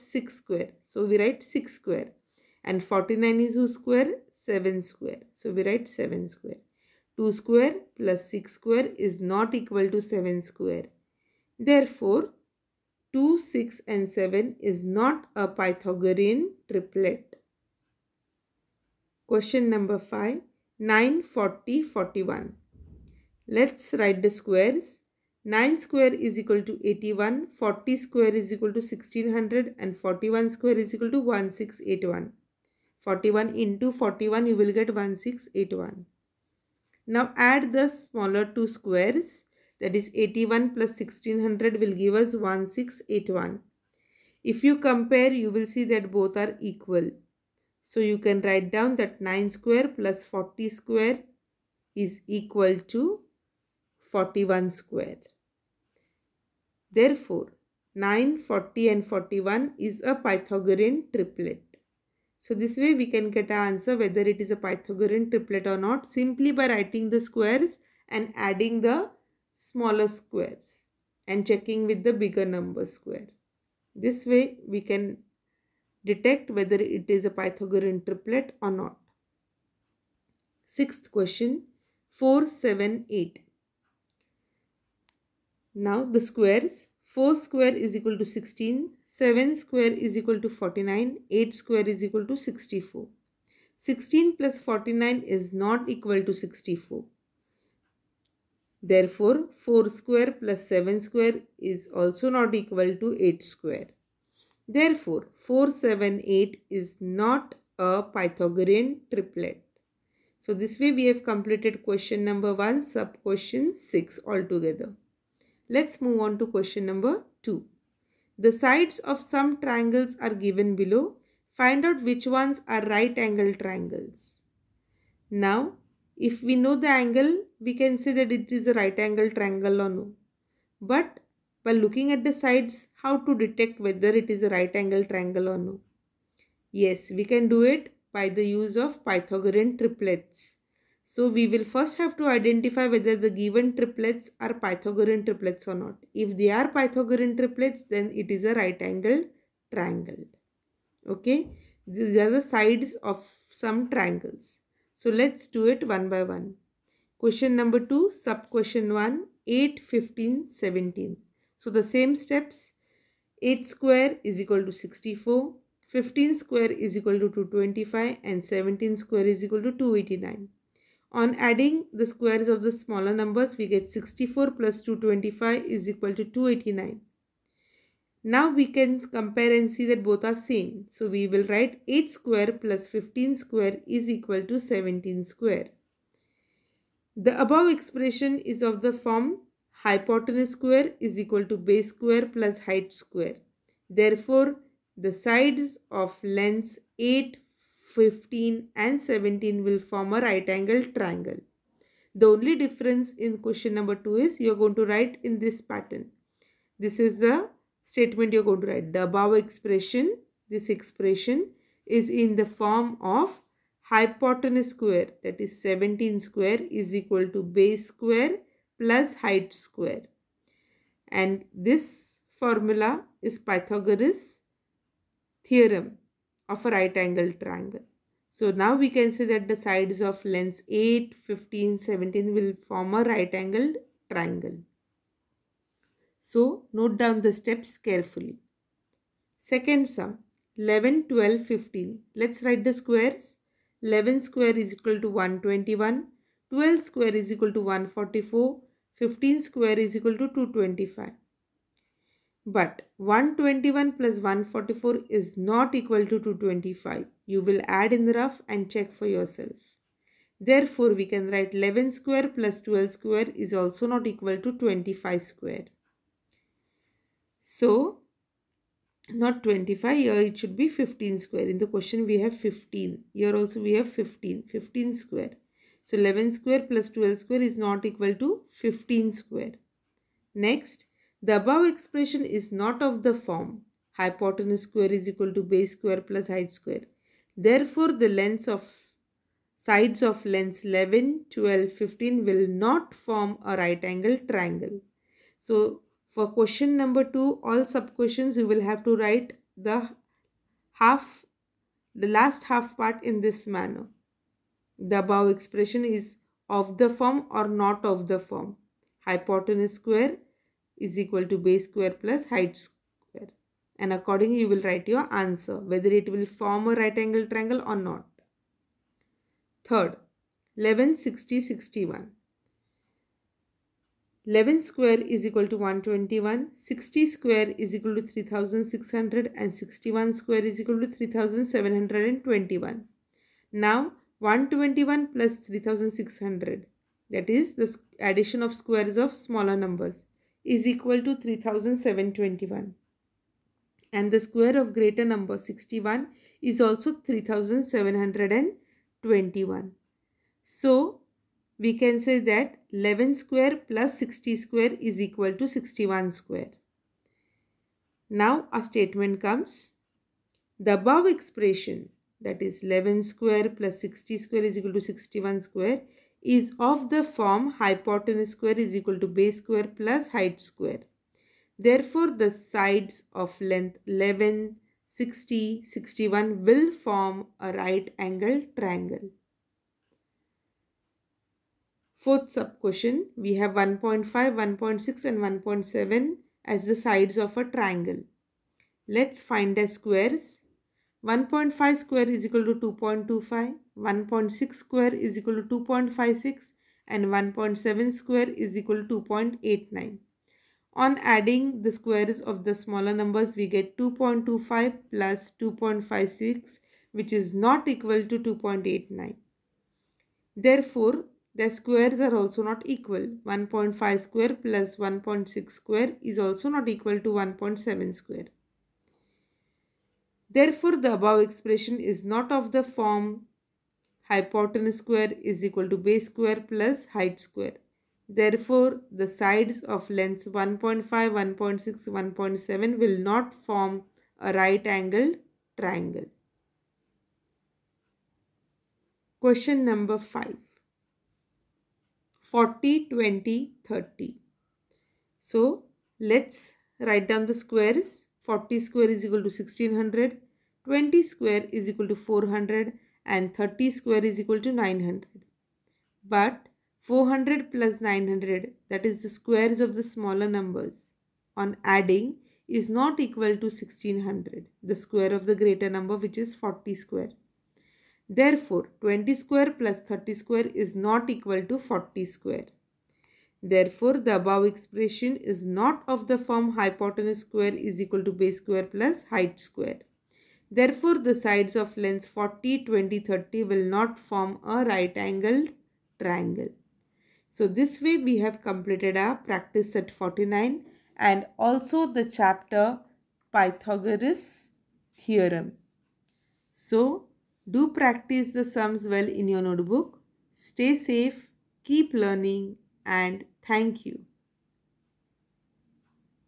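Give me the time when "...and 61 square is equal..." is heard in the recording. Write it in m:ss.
5:29.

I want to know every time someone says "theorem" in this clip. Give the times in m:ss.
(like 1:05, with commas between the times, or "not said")
3:45, 8:14.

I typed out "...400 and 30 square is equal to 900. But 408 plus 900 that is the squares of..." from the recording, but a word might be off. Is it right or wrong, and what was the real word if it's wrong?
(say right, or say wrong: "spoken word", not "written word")
wrong: "400", not "408".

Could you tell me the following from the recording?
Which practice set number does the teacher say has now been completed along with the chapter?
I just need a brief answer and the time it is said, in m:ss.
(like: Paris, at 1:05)
49, at 8:09.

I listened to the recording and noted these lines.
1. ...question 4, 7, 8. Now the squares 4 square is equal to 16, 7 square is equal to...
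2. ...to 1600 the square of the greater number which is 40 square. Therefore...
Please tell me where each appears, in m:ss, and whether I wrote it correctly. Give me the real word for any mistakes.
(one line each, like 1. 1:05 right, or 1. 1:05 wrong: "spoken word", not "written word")
1. 1:21 right
2. 7:43 right.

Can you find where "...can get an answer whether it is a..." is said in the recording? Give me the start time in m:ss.
1:03.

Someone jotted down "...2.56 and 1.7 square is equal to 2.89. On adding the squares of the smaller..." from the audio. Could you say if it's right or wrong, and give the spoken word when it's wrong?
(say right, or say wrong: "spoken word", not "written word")
right.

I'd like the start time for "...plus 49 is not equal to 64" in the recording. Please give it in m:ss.
1:34.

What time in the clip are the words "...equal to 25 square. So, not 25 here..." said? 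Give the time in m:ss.
4:24.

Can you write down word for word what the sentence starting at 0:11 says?
Therefore, 2, 6 and 7 is not a Pythagorean triplet.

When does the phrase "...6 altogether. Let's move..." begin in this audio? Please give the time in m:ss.
1:53.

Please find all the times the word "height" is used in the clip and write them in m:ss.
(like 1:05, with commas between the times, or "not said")
3:12, 3:39, 4:46, 5:12, 6:10, 7:06, 7:59.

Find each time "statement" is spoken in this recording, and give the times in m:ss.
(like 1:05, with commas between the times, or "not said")
3:27, 5:58.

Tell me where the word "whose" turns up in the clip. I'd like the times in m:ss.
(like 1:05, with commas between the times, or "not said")
0:03.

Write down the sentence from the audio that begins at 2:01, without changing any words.
Find out which ones are right angle triangles.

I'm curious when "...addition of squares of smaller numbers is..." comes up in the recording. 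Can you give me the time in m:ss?
5:37.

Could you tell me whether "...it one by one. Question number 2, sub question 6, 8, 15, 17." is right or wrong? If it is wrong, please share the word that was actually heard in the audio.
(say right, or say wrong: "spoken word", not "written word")
wrong: "1", not "6".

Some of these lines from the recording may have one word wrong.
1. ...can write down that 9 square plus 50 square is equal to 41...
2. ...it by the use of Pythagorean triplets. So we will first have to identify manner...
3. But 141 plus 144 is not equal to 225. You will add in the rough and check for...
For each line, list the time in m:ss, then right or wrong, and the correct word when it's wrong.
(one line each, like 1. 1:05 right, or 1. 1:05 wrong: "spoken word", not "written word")
1. 0:48 wrong: "40", not "50"
2. 2:17 wrong: "whether", not "manner"
3. 4:12 wrong: "121", not "141".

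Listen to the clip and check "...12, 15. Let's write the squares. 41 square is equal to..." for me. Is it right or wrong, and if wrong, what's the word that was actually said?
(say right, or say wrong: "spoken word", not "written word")
wrong: "11", not "41".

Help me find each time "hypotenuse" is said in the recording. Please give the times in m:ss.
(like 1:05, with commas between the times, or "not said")
3:09, 3:33, 4:43, 5:09, 6:07, 7:04, 7:56.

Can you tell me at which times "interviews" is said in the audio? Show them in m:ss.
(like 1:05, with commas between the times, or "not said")
not said.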